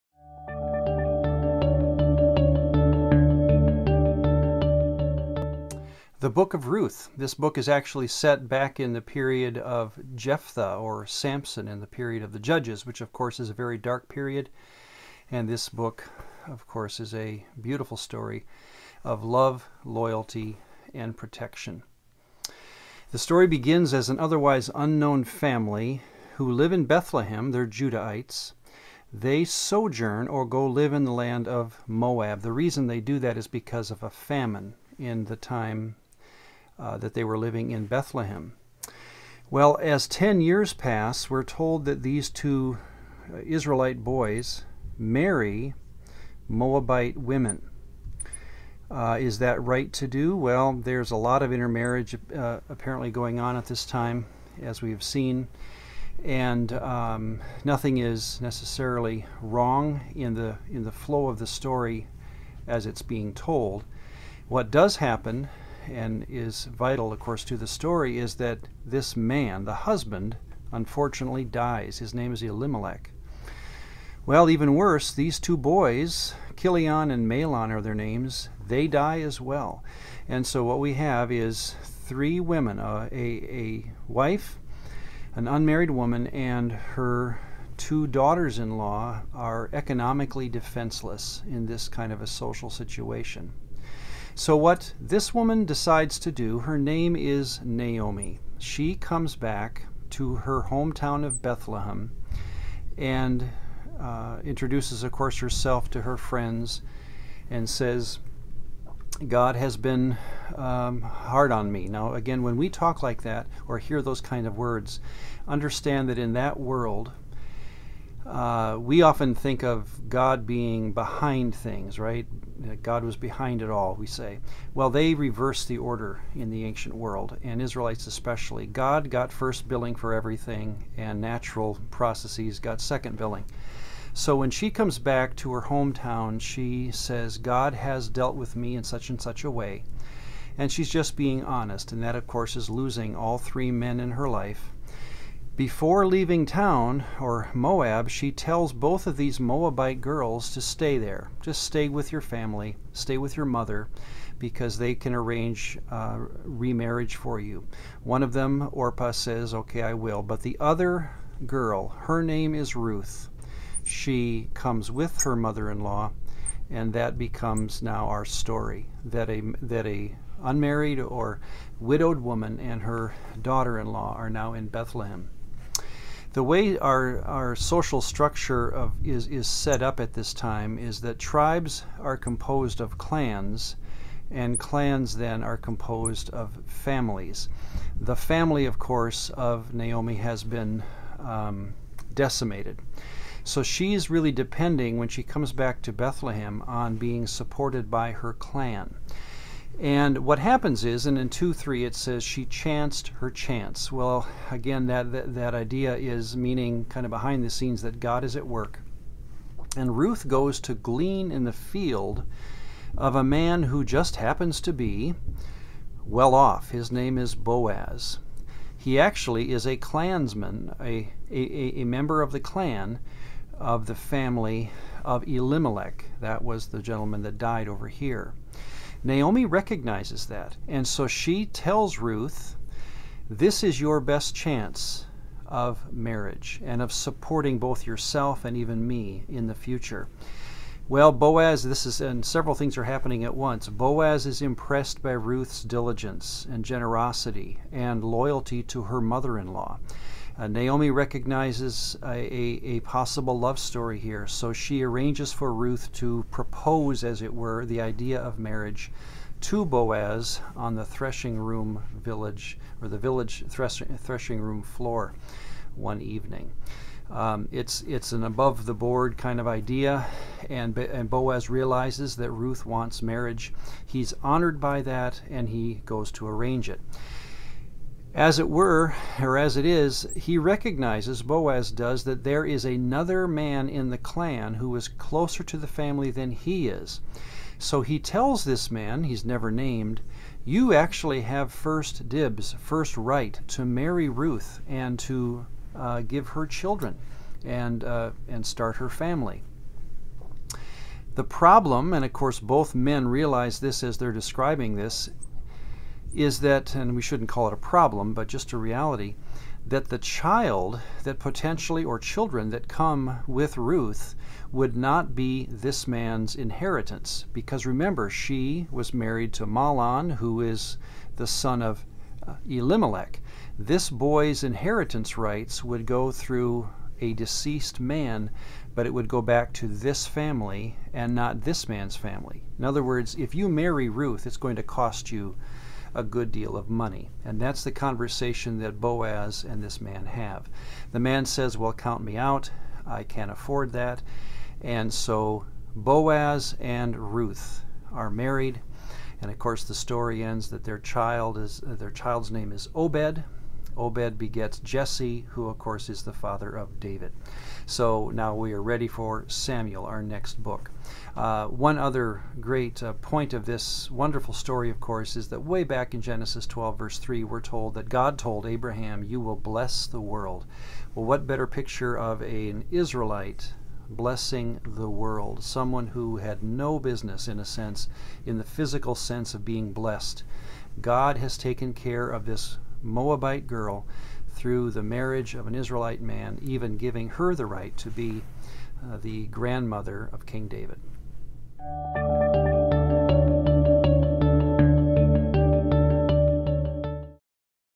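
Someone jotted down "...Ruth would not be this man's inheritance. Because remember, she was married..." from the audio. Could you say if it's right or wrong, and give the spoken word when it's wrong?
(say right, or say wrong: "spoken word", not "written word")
right.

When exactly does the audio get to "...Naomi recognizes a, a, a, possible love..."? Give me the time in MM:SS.
04:10.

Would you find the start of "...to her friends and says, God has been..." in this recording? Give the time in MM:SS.
01:45.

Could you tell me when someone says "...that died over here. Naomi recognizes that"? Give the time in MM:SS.
03:47.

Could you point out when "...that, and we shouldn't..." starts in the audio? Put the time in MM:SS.
05:06.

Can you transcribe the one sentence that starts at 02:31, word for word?
Just stay with your family, stay with your mother, because they can arrange uh, remarriage for you.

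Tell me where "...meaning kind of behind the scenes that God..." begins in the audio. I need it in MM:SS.
03:26.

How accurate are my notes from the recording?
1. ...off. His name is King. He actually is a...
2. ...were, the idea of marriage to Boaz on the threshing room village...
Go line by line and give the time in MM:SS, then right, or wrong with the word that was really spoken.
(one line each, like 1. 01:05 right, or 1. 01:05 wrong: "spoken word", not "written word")
1. 03:36 wrong: "Boaz", not "King"
2. 04:17 right.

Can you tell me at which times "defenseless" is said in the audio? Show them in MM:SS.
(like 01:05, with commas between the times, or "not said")
01:30.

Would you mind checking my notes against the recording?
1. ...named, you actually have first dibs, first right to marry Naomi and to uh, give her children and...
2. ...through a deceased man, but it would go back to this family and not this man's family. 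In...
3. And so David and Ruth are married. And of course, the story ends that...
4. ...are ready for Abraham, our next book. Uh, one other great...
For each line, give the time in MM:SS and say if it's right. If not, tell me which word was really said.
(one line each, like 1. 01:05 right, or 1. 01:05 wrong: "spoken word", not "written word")
1. 04:49 wrong: "Ruth", not "Naomi"
2. 05:26 right
3. 05:44 wrong: "Boaz", not "David"
4. 05:58 wrong: "Samuel", not "Abraham".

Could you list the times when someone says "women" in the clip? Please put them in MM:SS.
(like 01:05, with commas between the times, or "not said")
00:47, 01:22.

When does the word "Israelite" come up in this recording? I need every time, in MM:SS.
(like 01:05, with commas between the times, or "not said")
00:43, 02:07, 06:12, 06:25.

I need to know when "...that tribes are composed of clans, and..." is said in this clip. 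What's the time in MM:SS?
03:01.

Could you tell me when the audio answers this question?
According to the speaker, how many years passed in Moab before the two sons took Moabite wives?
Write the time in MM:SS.
00:40.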